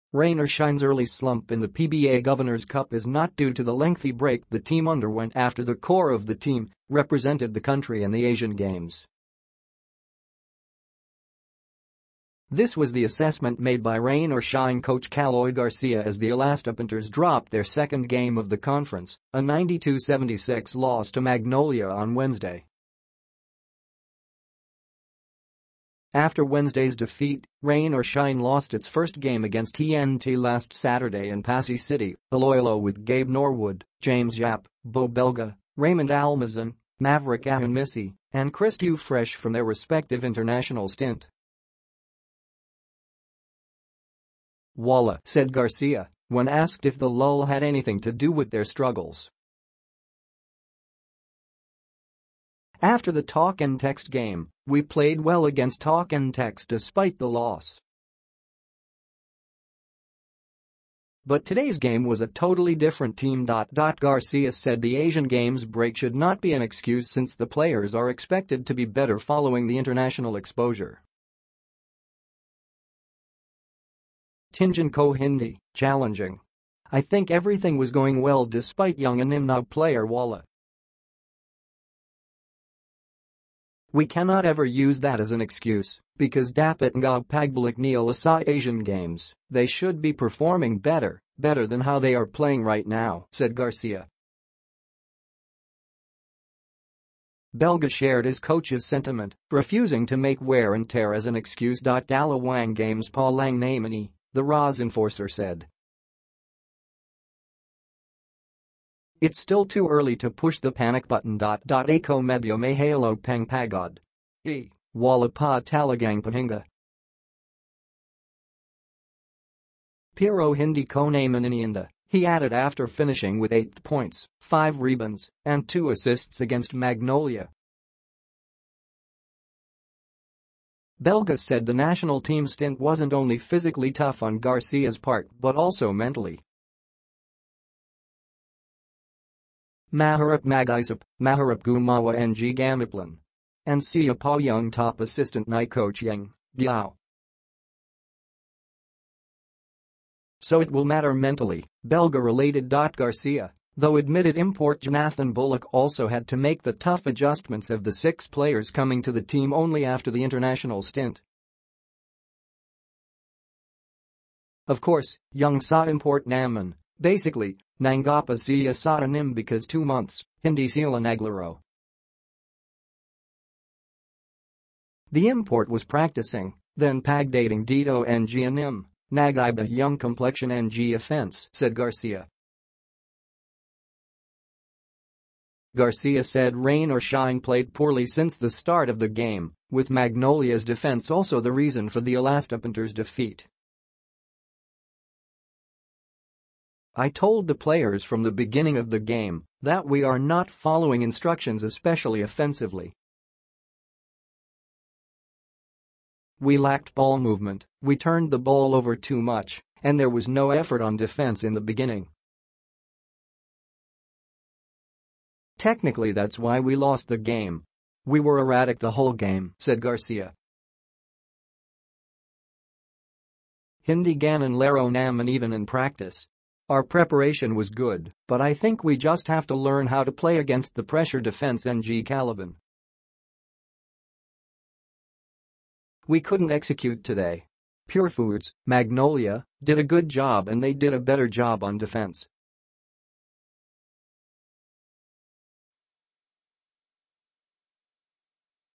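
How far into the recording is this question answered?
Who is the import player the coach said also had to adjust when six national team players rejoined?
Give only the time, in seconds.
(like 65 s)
154 s.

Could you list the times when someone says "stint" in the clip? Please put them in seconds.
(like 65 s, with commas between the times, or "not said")
40 s, 132 s, 160 s.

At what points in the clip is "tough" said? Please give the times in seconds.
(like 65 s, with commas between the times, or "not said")
133 s, 156 s.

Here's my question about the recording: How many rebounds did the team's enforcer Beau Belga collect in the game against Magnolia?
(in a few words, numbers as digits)
5.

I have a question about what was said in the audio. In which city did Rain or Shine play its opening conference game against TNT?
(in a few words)
Passi City.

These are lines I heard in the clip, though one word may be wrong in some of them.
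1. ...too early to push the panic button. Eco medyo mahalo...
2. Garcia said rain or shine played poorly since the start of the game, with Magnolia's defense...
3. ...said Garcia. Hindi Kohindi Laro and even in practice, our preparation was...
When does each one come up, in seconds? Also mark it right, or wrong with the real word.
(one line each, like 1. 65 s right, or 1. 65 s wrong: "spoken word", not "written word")
1. 109 s right
2. 185 s right
3. 219 s wrong: "Ganon", not "Kohindi".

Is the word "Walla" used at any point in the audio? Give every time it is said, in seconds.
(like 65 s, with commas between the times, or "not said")
44 s, 80 s.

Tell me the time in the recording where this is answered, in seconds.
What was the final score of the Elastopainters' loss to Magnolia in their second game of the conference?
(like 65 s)
19 s.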